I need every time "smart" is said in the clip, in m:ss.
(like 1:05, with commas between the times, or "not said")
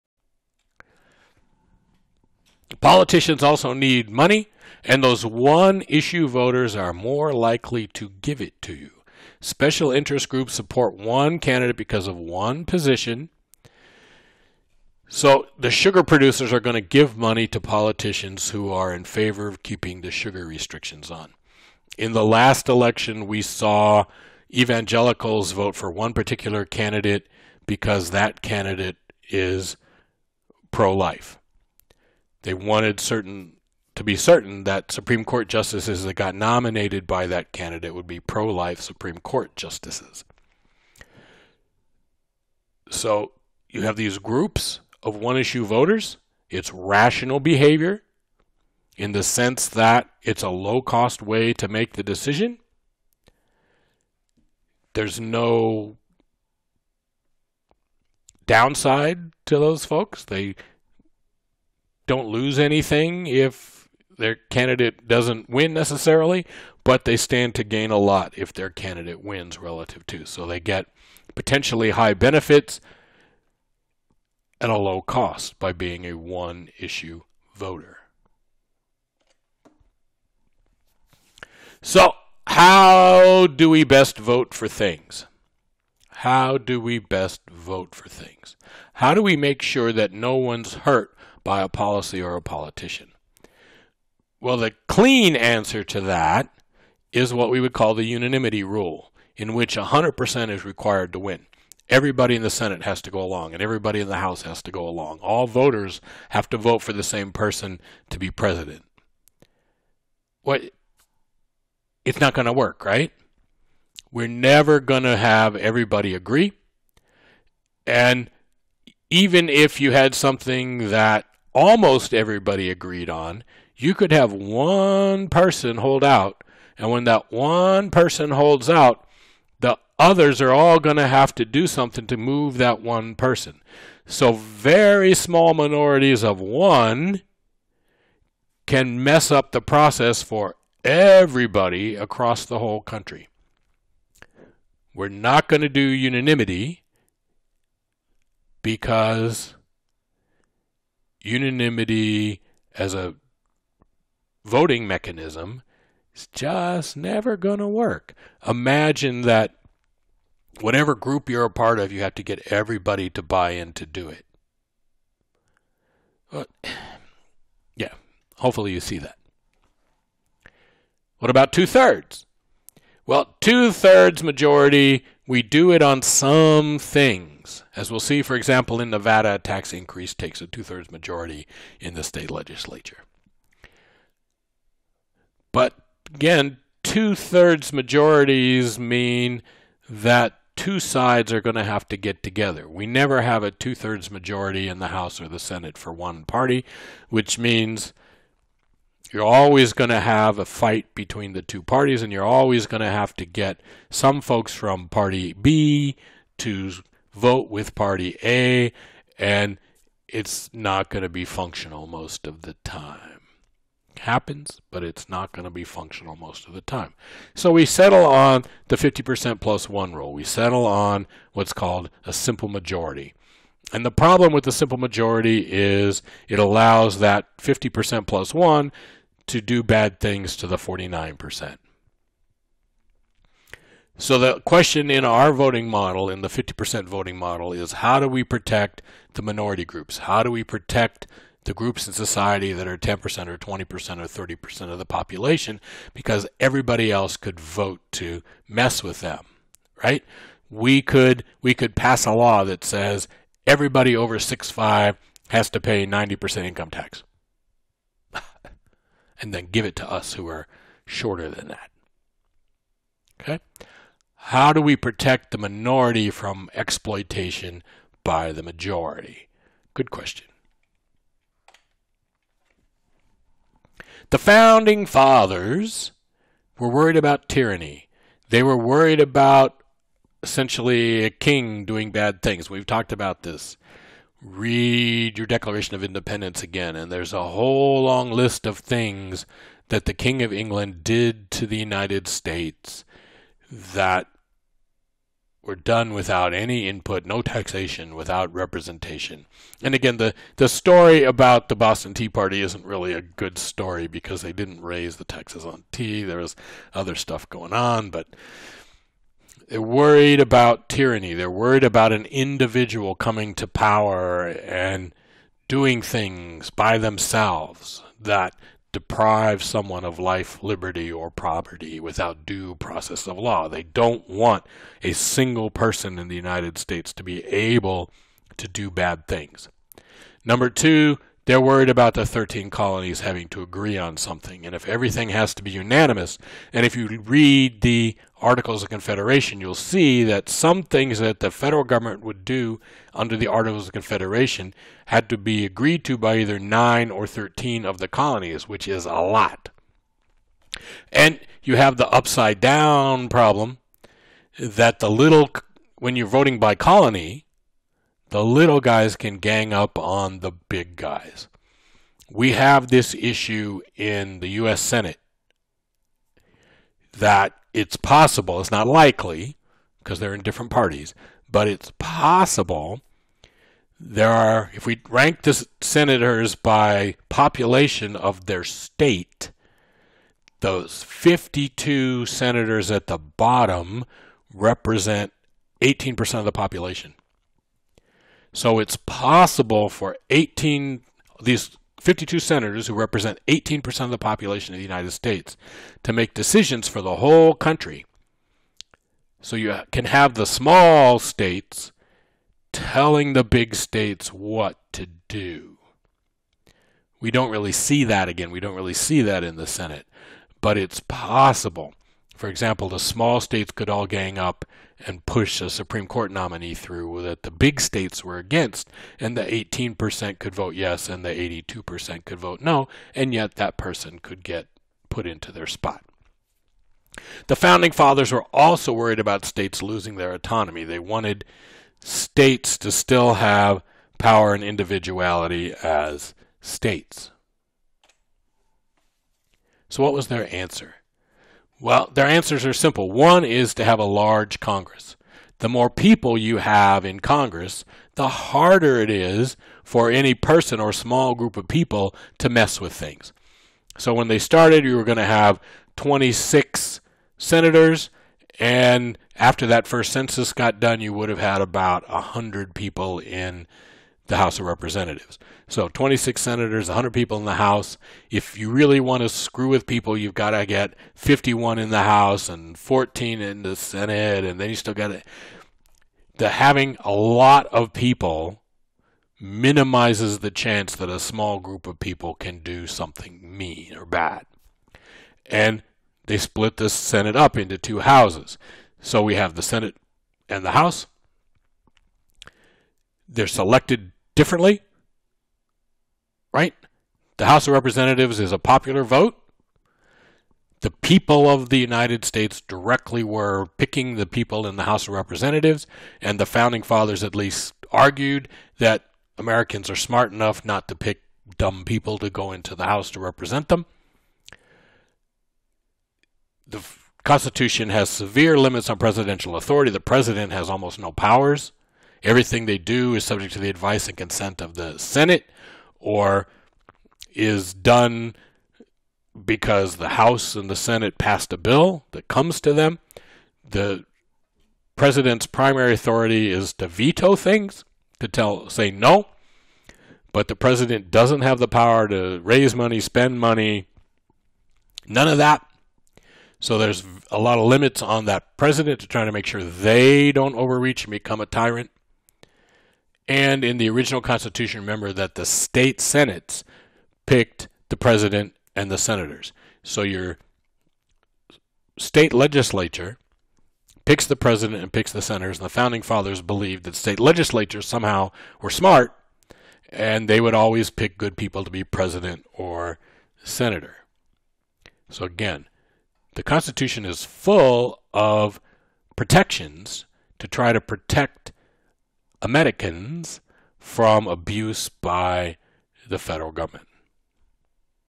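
8:29, 9:28.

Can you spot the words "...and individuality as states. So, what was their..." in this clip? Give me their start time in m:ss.
7:14.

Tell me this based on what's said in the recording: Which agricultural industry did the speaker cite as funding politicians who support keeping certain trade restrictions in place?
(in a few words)
sugar producers.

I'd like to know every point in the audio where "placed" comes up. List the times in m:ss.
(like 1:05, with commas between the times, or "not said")
not said.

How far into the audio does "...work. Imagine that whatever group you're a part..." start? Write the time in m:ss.
2:37.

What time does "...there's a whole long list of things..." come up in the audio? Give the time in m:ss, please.
4:46.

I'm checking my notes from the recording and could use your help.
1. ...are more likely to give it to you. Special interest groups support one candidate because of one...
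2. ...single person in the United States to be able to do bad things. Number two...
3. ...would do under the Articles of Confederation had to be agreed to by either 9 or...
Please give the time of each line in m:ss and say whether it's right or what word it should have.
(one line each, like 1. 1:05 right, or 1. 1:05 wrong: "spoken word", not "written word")
1. 0:06 right
2. 5:24 right
3. 5:42 right.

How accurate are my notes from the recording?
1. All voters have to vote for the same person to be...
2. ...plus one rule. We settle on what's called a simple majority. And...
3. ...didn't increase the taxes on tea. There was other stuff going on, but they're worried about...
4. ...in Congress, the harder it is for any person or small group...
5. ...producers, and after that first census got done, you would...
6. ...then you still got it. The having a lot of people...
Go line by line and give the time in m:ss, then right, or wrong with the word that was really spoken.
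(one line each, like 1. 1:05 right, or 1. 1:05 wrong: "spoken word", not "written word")
1. 1:45 right
2. 3:39 right
3. 5:04 wrong: "raise", not "increase"
4. 7:26 right
5. 7:37 wrong: "senators", not "producers"
6. 7:54 right.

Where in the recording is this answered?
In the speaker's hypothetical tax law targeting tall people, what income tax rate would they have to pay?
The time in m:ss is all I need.
4:15.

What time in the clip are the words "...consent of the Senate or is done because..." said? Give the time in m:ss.
8:43.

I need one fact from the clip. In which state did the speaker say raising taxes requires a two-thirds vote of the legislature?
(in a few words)
Nevada.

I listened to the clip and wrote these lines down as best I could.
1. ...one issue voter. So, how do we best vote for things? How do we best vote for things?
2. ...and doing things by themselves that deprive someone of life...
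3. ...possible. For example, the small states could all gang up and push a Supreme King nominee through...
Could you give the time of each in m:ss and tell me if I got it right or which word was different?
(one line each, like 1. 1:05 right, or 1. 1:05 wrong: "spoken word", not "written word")
1. 1:16 right
2. 5:14 right
3. 6:50 wrong: "Court", not "King".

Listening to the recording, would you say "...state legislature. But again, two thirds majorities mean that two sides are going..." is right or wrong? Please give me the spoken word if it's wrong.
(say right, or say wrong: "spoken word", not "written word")
right.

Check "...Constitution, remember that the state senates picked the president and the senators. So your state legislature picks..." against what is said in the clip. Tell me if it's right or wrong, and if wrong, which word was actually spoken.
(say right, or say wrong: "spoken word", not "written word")
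right.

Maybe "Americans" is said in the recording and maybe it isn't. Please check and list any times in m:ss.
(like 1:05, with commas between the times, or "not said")
8:29, 9:42.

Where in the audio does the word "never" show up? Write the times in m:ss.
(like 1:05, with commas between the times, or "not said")
1:54, 2:36, 3:12.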